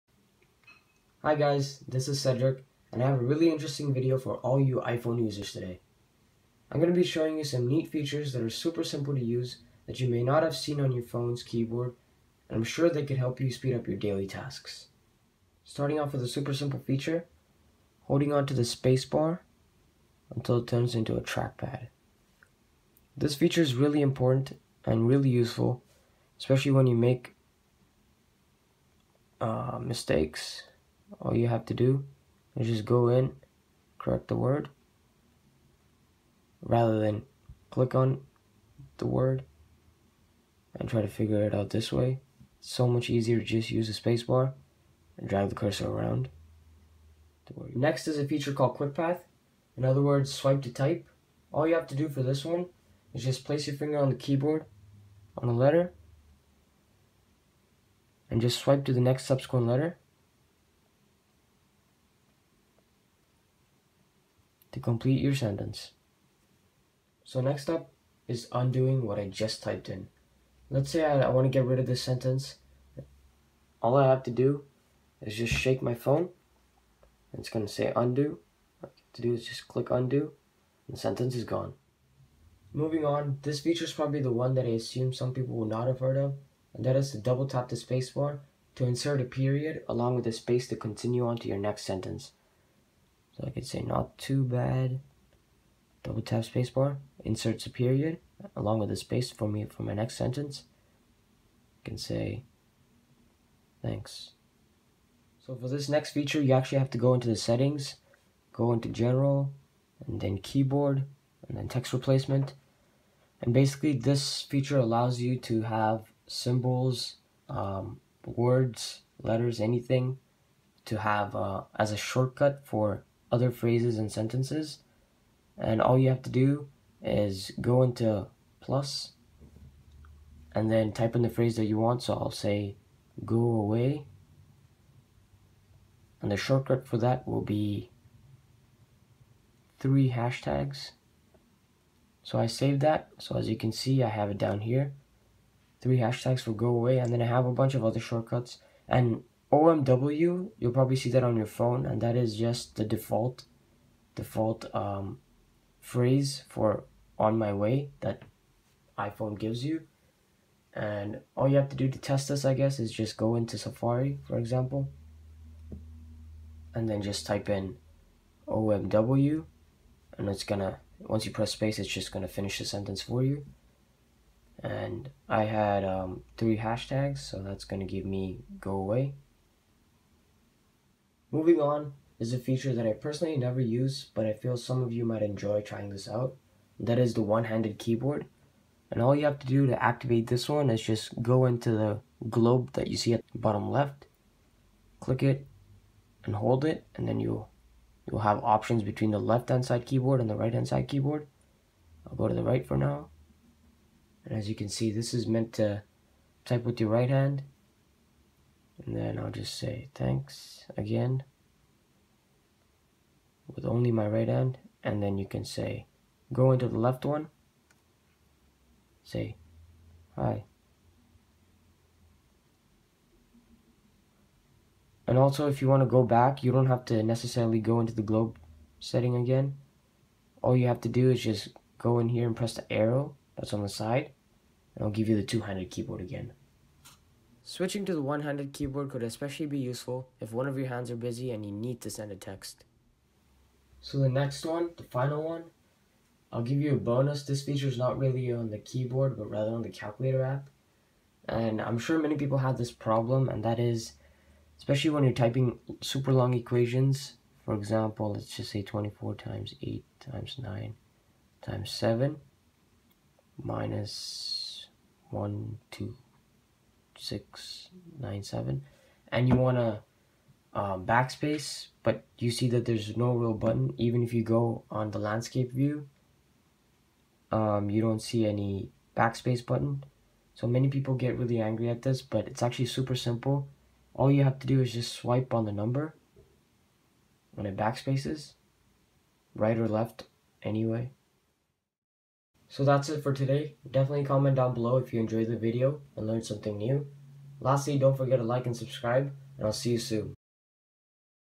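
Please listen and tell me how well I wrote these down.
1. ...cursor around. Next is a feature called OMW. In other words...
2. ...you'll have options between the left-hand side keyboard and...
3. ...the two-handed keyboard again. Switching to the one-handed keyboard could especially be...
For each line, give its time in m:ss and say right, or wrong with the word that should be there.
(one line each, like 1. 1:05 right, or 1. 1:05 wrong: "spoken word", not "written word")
1. 0:45 wrong: "QuickPath", not "OMW"
2. 3:18 right
3. 3:55 right.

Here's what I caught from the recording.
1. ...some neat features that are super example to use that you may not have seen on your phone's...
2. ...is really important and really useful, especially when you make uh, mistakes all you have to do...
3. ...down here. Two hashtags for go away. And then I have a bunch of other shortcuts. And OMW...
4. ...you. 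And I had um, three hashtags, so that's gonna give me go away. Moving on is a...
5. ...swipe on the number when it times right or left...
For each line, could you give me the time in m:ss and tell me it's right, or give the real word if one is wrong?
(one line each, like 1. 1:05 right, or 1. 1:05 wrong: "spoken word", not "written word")
1. 0:07 wrong: "simple", not "example"
2. 0:23 right
3. 2:24 wrong: "Three", not "Two"
4. 2:53 right
5. 4:44 wrong: "backspaces", not "times".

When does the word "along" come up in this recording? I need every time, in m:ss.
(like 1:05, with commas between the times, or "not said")
1:29, 1:38.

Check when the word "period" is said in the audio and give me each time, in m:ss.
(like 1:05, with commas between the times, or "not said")
1:29, 1:37.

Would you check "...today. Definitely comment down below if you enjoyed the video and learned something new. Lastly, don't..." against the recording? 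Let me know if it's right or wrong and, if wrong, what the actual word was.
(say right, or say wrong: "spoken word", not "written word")
right.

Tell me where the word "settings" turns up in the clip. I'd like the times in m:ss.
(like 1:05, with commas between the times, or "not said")
1:47, 3:48.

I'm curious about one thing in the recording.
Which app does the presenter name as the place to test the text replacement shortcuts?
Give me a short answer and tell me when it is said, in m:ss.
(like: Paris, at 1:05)
Safari, at 2:43.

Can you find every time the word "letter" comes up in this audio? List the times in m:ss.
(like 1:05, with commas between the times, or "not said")
0:55, 0:59, 1:59.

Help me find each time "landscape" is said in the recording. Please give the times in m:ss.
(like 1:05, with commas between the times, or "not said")
4:34.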